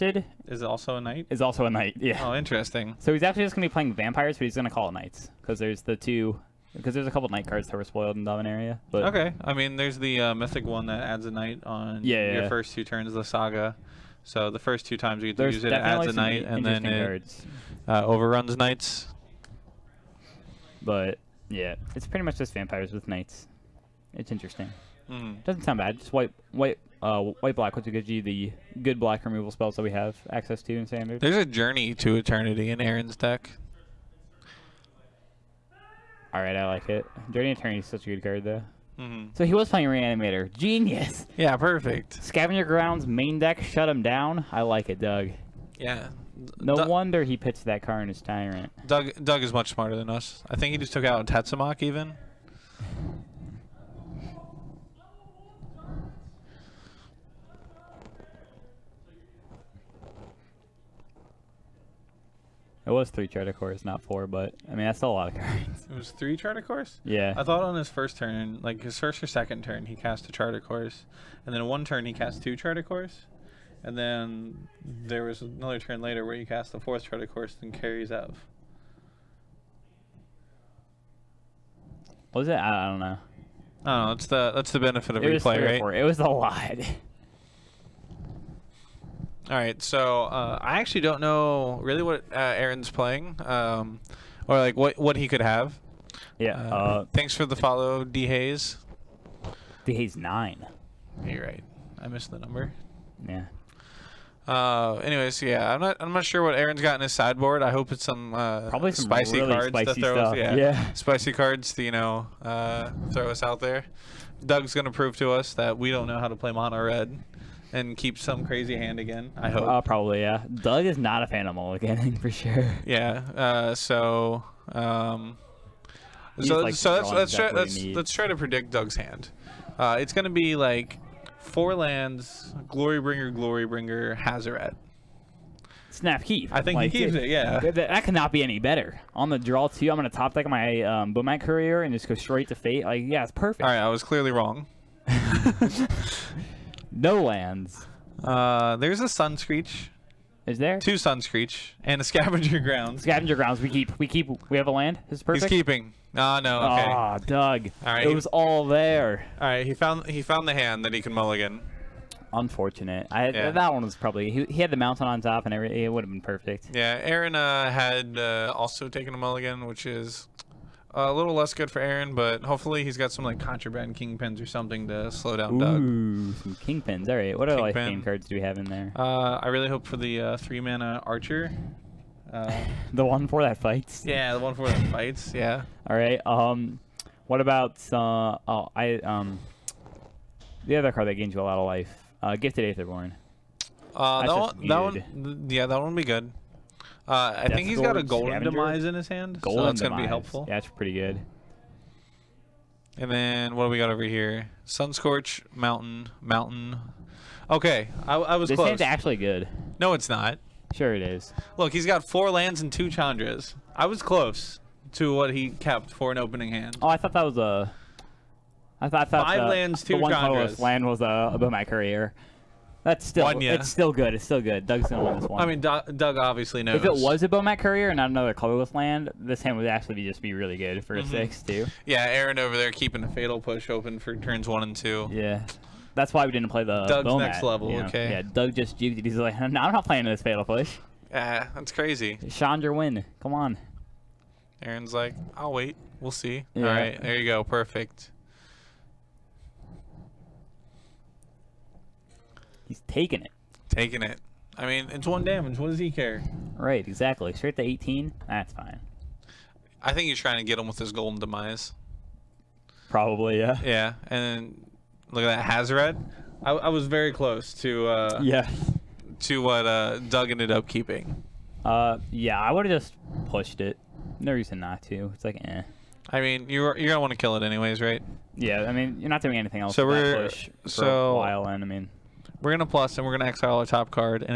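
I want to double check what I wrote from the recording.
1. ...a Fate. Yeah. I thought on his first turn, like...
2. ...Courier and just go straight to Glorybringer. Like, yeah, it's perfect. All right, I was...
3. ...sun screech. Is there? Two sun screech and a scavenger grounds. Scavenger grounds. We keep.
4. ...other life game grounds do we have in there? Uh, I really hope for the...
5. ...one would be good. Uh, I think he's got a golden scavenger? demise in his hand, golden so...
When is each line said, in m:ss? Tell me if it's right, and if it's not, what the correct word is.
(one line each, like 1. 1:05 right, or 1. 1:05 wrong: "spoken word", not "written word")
1. 1:06 wrong: "Course", not "Fate"
2. 2:21 wrong: "Fate", not "Glorybringer"
3. 2:29 right
4. 2:57 wrong: "cards", not "grounds"
5. 3:15 right.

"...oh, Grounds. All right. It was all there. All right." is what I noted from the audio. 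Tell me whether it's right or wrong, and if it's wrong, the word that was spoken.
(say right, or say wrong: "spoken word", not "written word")
wrong: "Doug", not "Grounds".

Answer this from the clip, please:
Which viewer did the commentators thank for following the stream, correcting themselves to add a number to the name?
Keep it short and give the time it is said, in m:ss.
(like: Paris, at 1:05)
D Hayes nine, at 1:39.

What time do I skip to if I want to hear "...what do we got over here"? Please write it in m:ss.
3:23.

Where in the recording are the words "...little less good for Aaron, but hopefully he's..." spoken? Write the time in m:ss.
2:51.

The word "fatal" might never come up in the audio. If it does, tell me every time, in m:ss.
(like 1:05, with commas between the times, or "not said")
3:53, 4:00.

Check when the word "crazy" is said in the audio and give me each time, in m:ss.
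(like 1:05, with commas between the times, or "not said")
1:58, 4:01.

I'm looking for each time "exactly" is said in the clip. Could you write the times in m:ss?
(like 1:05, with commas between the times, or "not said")
4:16.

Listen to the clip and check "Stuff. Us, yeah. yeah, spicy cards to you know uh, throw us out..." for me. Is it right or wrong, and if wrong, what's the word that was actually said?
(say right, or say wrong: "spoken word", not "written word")
right.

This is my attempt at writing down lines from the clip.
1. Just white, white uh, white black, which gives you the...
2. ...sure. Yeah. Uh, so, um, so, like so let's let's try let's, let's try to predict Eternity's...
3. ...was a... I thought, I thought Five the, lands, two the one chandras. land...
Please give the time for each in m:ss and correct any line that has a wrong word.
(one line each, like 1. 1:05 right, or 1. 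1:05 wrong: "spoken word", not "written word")
1. 0:25 right
2. 2:02 wrong: "Doug", not "Eternity"
3. 3:37 right.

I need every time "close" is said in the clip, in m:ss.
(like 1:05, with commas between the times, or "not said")
3:28, 3:34, 4:27.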